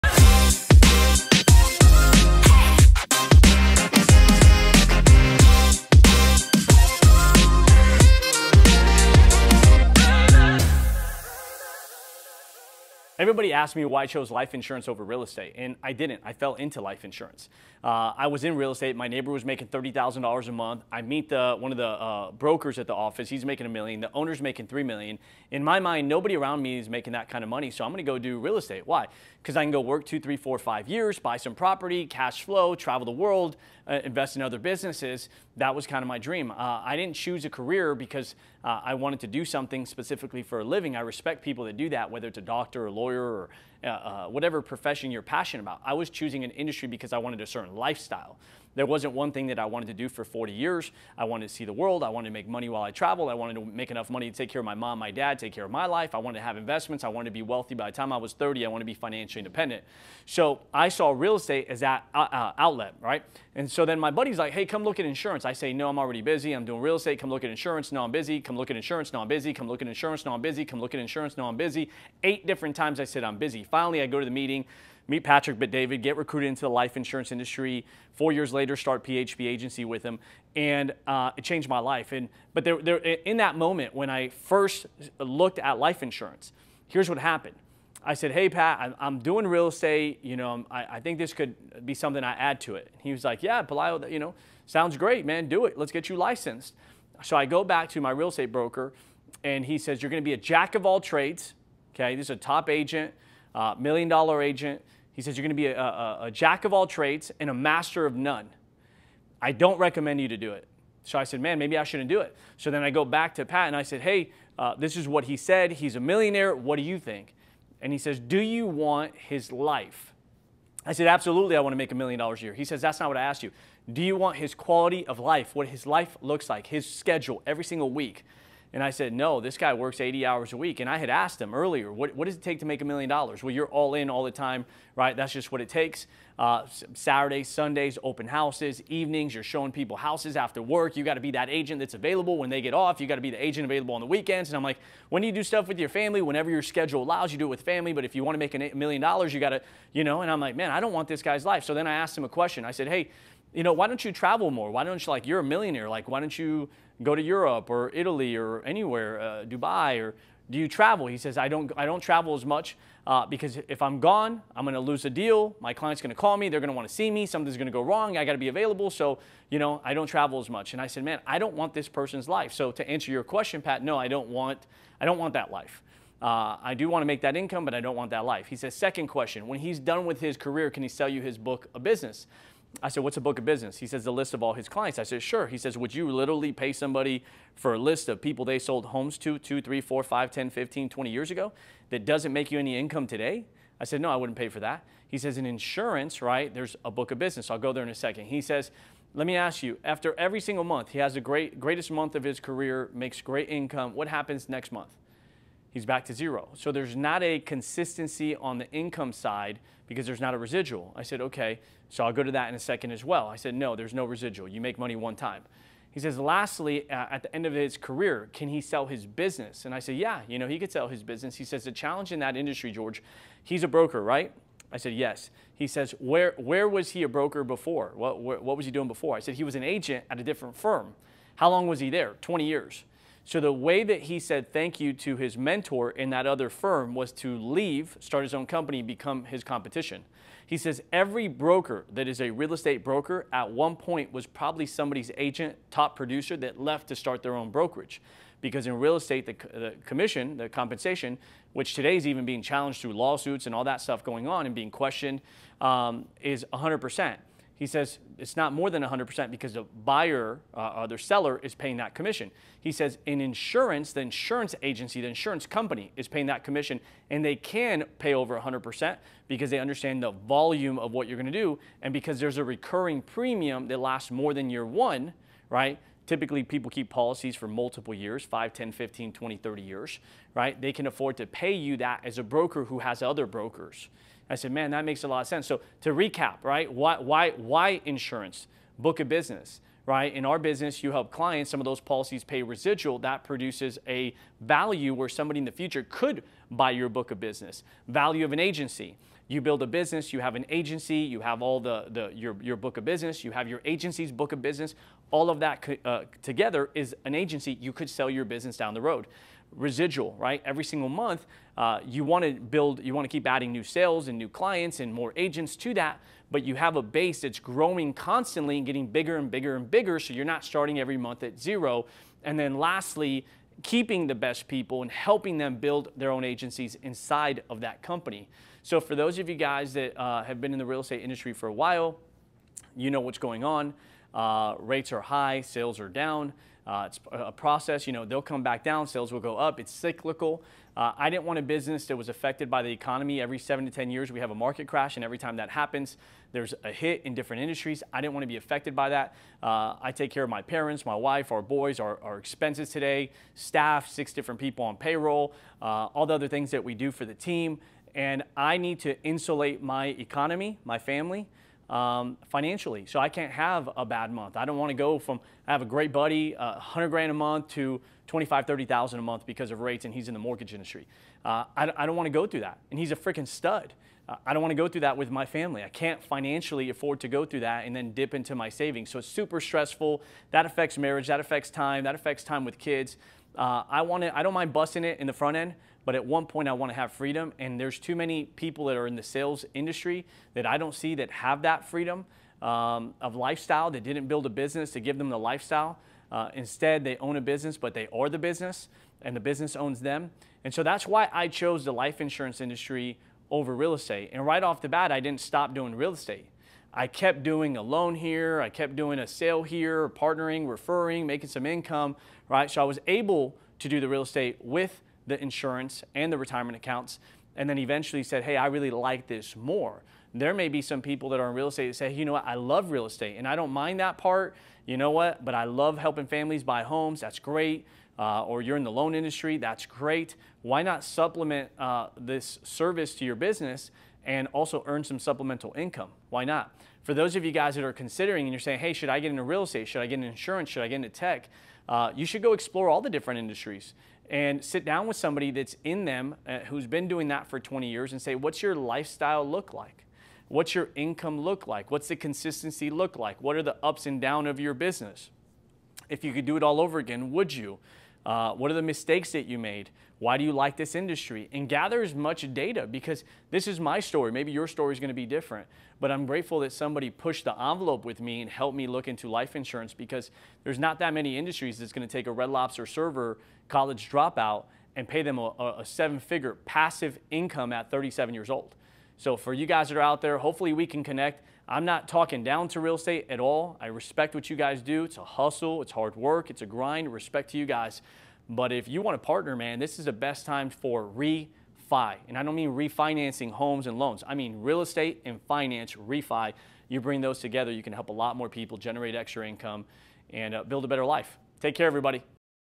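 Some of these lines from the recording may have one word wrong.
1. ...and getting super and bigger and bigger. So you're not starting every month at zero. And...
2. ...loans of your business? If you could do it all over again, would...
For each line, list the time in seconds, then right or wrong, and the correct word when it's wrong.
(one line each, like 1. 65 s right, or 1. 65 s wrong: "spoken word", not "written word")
1. 318 s wrong: "bigger", not "super"
2. 453 s wrong: "downs", not "loans".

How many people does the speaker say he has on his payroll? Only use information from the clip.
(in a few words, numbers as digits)
6.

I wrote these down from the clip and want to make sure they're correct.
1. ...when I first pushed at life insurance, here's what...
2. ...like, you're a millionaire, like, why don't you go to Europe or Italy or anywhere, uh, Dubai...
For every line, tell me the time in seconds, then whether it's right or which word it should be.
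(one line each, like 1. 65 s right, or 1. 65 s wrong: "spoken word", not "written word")
1. 83 s wrong: "looked", not "pushed"
2. 155 s right.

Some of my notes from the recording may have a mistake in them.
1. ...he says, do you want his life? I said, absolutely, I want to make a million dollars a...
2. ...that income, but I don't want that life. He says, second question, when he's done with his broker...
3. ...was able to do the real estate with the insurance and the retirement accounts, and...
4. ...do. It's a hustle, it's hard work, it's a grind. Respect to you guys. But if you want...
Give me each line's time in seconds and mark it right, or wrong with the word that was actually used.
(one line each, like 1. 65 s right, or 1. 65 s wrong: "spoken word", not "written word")
1. 117 s right
2. 177 s wrong: "career", not "broker"
3. 412 s right
4. 484 s right.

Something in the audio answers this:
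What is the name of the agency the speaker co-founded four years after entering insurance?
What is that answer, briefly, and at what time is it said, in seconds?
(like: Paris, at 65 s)
PHP Agency, at 79 s.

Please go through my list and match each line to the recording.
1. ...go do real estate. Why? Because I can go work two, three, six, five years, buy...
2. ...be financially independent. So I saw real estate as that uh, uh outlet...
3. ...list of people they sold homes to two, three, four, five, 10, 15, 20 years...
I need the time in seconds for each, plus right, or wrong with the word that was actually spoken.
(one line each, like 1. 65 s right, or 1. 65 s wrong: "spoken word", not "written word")
1. 28 s wrong: "four", not "six"
2. 58 s right
3. 187 s right.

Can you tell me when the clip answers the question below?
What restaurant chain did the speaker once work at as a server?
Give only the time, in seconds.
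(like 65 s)
472 s.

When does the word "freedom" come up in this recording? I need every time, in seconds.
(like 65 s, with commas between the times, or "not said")
386 s, 391 s.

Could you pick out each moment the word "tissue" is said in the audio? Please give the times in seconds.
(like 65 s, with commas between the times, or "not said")
not said.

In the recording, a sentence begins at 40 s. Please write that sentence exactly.
I respect people that do that, whether it's a doctor or lawyer lawyer or uh, uh, whatever profession you're passionate about.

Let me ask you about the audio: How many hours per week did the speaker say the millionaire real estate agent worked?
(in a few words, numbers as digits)
80.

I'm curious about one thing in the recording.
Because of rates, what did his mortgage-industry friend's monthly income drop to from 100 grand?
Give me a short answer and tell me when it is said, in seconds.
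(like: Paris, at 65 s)
25,000 to 30,000, at 368 s.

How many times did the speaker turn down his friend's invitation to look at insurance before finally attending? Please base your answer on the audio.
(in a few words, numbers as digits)
8.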